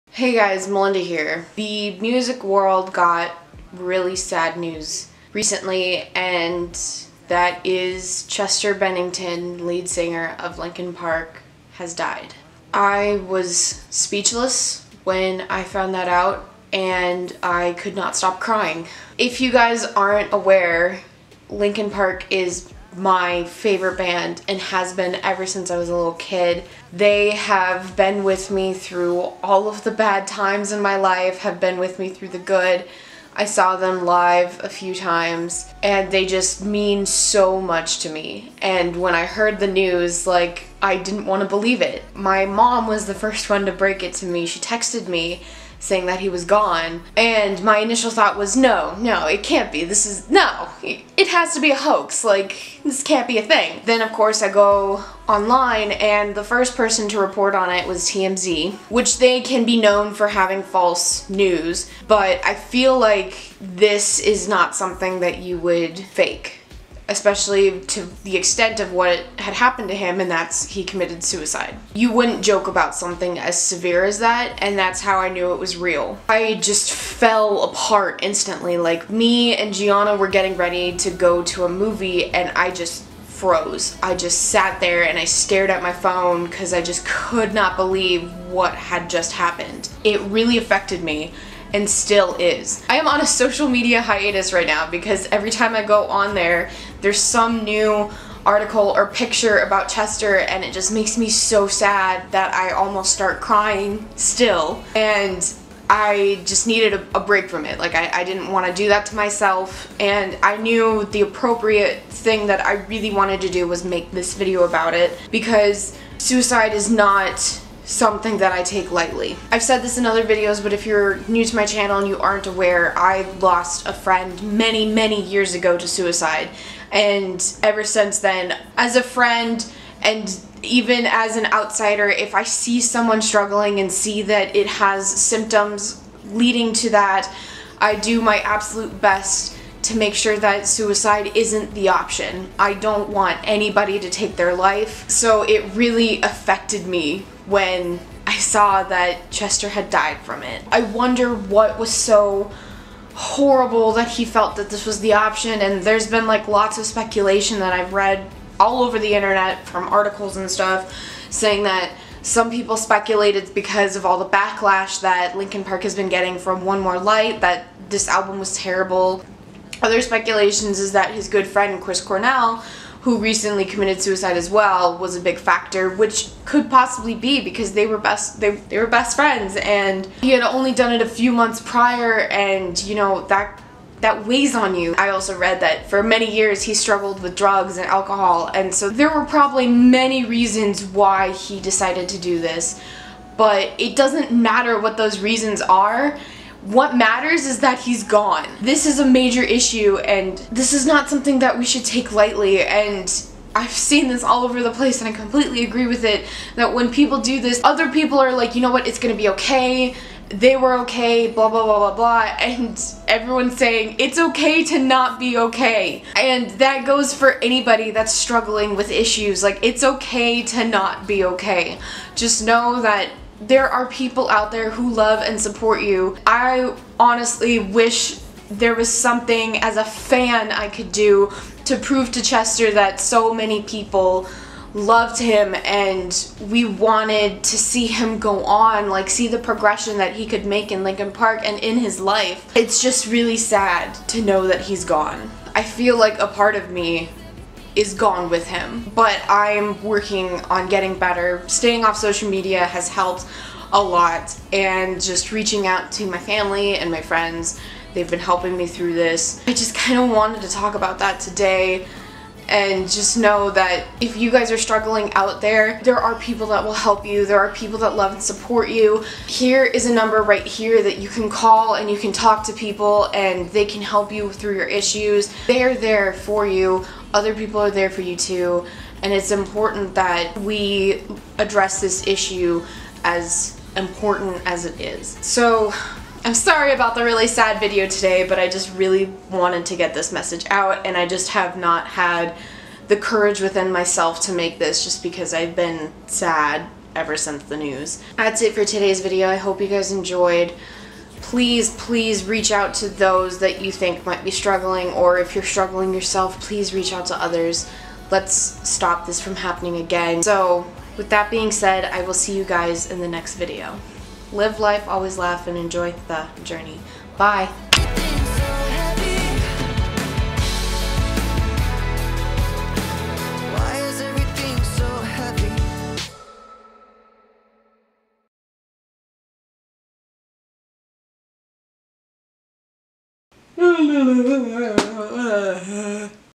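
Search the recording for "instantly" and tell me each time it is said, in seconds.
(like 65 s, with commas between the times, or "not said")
78 s.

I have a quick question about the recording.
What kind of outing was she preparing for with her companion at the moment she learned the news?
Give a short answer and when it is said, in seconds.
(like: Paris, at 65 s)
A movie, at 81 s.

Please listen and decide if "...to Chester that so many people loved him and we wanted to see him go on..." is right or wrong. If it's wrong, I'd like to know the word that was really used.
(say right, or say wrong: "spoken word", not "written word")
right.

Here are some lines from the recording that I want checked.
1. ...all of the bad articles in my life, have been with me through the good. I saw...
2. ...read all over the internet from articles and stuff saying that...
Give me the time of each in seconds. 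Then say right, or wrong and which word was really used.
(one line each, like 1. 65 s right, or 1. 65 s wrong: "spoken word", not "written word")
1. 29 s wrong: "times", not "articles"
2. 157 s right.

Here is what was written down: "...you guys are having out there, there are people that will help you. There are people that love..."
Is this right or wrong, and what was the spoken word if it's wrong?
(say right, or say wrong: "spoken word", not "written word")
wrong: "struggling", not "having".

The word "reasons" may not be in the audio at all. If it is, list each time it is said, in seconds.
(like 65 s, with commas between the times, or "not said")
190 s, 195 s.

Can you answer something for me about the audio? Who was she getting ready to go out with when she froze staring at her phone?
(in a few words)
Gianna.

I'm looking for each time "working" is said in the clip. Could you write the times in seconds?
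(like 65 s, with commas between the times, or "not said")
249 s.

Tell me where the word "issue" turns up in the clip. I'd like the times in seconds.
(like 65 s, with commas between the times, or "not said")
199 s, 218 s, 274 s, 282 s.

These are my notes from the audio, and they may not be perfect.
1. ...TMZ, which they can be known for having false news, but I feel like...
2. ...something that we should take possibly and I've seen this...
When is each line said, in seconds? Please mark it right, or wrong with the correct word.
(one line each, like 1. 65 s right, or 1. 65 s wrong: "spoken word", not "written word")
1. 58 s right
2. 201 s wrong: "lightly", not "possibly".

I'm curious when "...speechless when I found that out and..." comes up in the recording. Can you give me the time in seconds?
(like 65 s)
13 s.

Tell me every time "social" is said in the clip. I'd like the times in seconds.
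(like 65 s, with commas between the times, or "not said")
93 s, 251 s.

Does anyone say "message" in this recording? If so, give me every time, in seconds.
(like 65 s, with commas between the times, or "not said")
290 s.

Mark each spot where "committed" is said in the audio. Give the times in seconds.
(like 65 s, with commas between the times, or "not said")
70 s, 173 s.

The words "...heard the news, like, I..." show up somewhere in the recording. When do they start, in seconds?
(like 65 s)
39 s.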